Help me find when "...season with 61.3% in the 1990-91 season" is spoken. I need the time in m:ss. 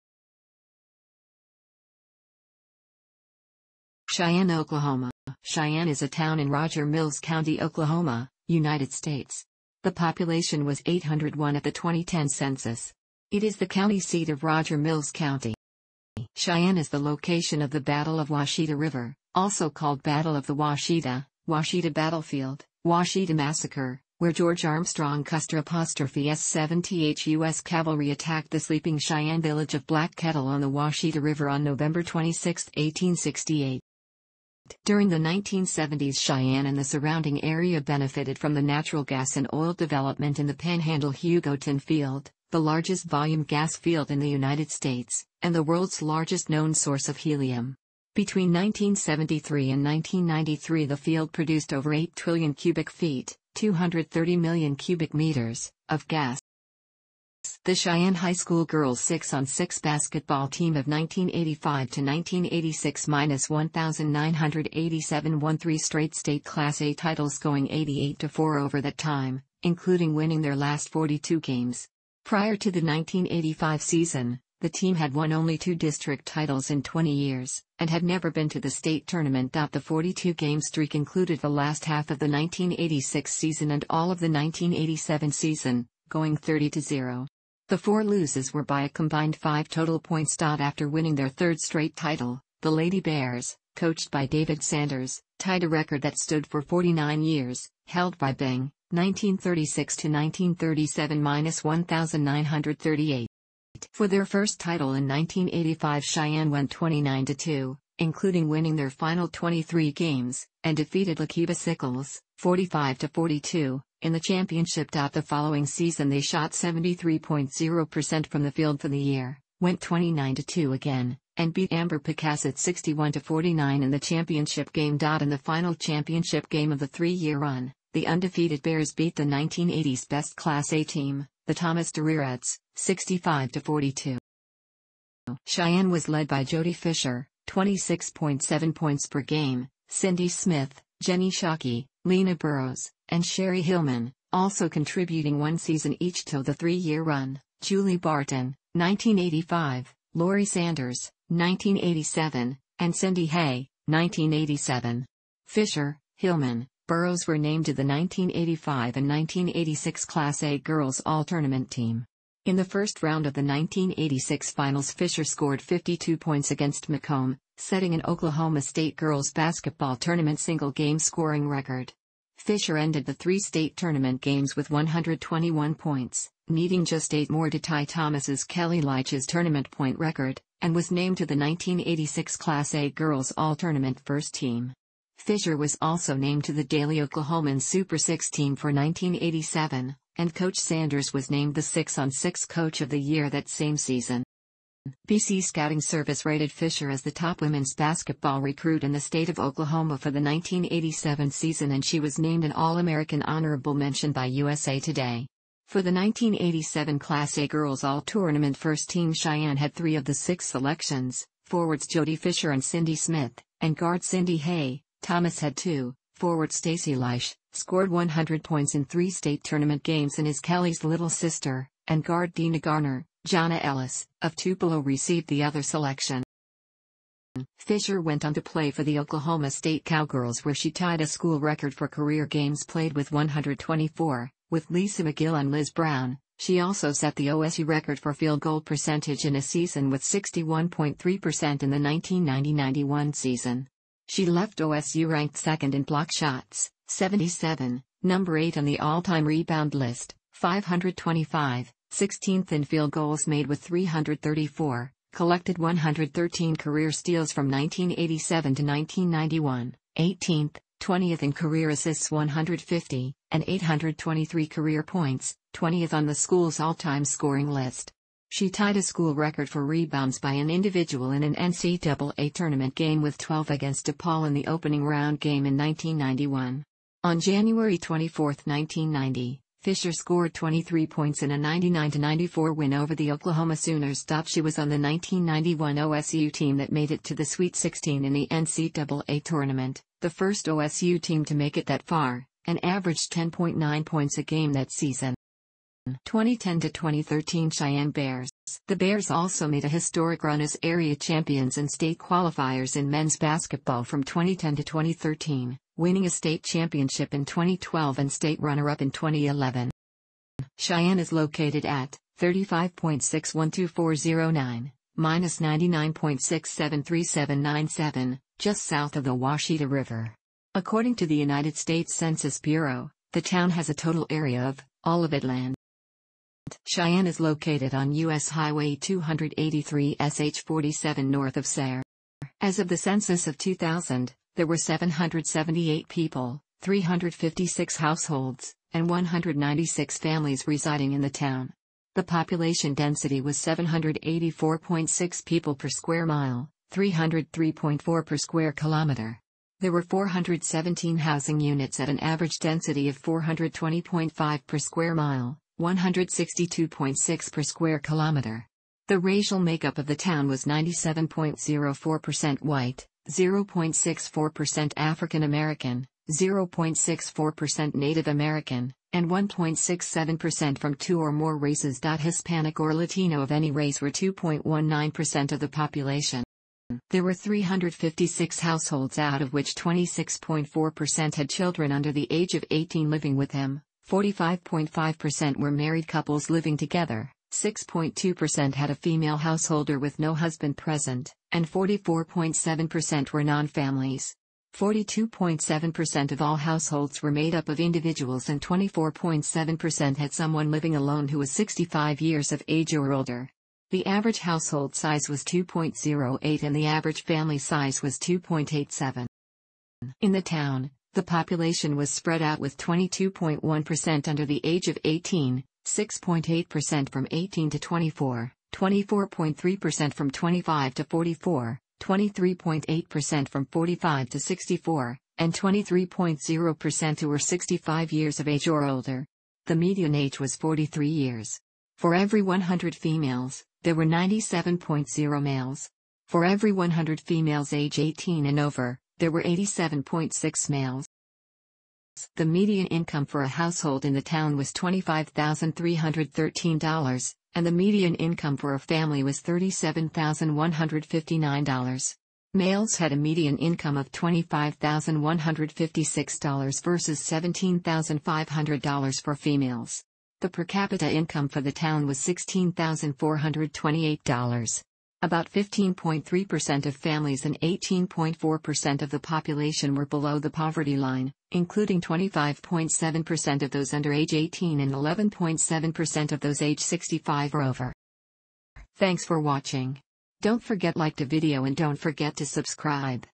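3:59.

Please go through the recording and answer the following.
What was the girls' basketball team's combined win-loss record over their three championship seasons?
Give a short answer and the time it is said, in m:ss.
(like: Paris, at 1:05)
88-4, at 1:07.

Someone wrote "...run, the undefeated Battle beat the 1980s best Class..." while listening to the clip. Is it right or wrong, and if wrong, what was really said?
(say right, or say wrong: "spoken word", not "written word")
wrong: "Bears", not "Battle".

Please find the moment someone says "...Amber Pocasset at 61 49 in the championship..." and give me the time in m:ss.
2:01.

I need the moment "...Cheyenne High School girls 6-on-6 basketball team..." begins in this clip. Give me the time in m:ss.
0:57.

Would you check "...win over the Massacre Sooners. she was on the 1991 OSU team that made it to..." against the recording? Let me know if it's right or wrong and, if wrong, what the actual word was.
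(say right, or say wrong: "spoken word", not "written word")
wrong: "Oklahoma", not "Massacre".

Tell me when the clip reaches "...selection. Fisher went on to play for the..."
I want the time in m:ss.
3:45.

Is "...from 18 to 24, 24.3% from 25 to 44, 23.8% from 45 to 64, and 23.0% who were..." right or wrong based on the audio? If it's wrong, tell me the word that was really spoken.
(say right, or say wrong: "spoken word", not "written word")
right.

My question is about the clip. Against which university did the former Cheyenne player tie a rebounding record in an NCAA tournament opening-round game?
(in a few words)
DePaul.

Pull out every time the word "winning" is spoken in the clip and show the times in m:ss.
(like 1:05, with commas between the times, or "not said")
1:10, 1:30, 1:48, 5:05.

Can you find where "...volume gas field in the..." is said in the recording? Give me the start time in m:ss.
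0:43.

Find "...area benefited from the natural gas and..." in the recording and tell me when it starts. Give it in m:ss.
0:37.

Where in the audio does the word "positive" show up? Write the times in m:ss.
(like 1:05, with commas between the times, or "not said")
not said.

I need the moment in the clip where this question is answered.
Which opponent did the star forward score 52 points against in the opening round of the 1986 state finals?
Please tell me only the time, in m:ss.
2:46.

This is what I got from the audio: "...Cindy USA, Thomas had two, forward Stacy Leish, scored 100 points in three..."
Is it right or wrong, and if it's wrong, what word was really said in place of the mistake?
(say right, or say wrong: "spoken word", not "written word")
wrong: "Hay", not "USA".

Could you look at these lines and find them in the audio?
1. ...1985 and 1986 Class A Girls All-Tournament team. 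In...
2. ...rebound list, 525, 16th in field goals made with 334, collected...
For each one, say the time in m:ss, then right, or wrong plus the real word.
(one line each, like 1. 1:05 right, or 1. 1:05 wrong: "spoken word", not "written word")
1. 2:37 right
2. 4:09 right.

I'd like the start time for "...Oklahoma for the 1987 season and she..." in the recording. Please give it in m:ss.
3:19.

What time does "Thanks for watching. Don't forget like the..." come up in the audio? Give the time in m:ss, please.
7:58.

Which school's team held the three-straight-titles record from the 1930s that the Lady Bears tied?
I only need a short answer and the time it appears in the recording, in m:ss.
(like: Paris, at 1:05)
Byng, at 1:38.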